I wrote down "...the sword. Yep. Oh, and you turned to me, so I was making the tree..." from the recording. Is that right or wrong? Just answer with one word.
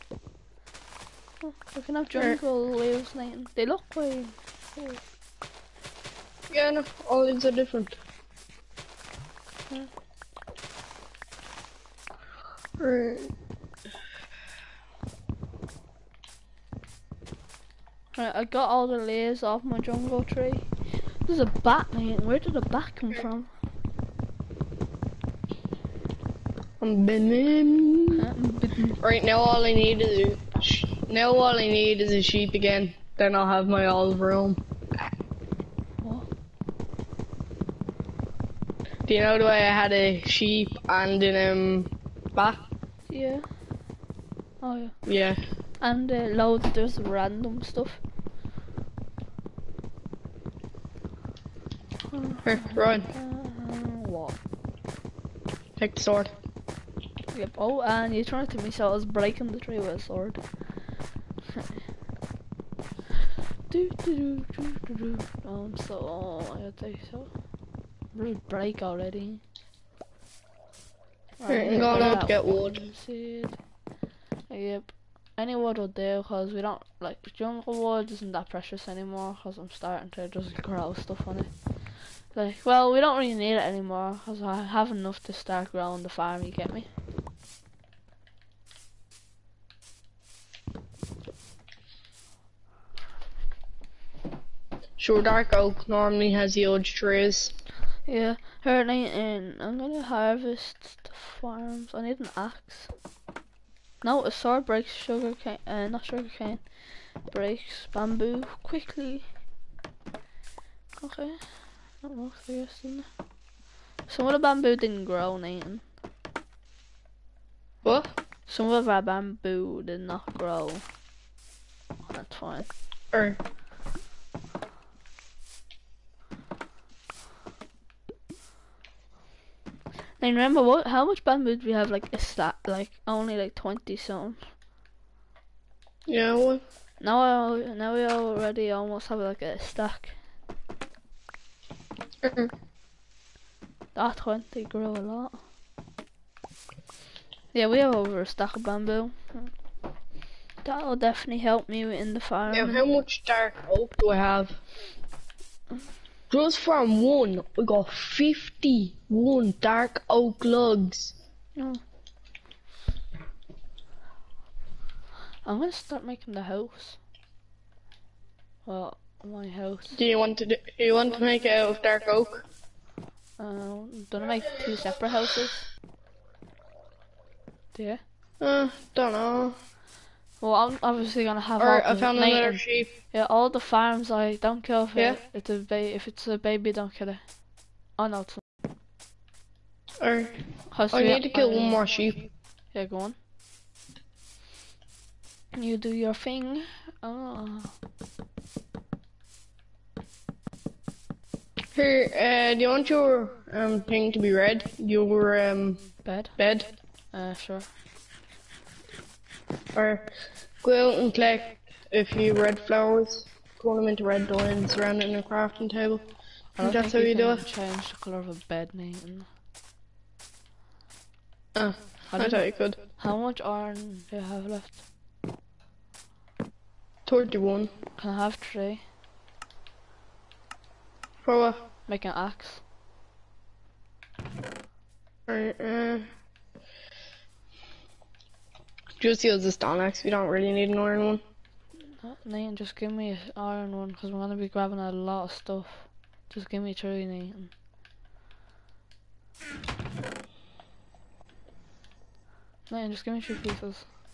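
wrong.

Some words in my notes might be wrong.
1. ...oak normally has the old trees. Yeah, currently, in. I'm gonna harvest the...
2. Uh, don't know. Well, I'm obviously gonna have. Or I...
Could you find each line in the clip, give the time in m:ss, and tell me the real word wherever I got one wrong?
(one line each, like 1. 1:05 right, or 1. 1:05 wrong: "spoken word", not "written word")
1. 1:35 right
2. 2:58 right.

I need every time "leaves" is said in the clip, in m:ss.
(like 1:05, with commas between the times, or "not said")
0:02, 0:07, 0:18.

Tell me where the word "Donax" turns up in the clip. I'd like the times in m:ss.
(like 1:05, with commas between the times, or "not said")
3:59.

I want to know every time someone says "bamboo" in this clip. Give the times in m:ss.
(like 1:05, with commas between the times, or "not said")
1:47, 1:54, 1:59, 2:11, 2:28.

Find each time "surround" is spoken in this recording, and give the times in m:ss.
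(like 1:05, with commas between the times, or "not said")
3:34.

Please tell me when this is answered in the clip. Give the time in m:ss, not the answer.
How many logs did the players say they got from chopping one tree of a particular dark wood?
2:37.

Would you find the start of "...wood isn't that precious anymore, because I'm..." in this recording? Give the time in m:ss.
1:17.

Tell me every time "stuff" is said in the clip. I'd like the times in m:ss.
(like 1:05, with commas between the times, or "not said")
0:47, 1:20, 4:05.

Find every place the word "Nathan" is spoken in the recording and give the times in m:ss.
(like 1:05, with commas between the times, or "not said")
0:03, 1:55, 3:38, 4:02, 4:07, 4:12.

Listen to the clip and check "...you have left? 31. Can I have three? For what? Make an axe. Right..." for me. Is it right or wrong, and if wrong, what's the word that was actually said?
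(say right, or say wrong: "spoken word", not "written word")
right.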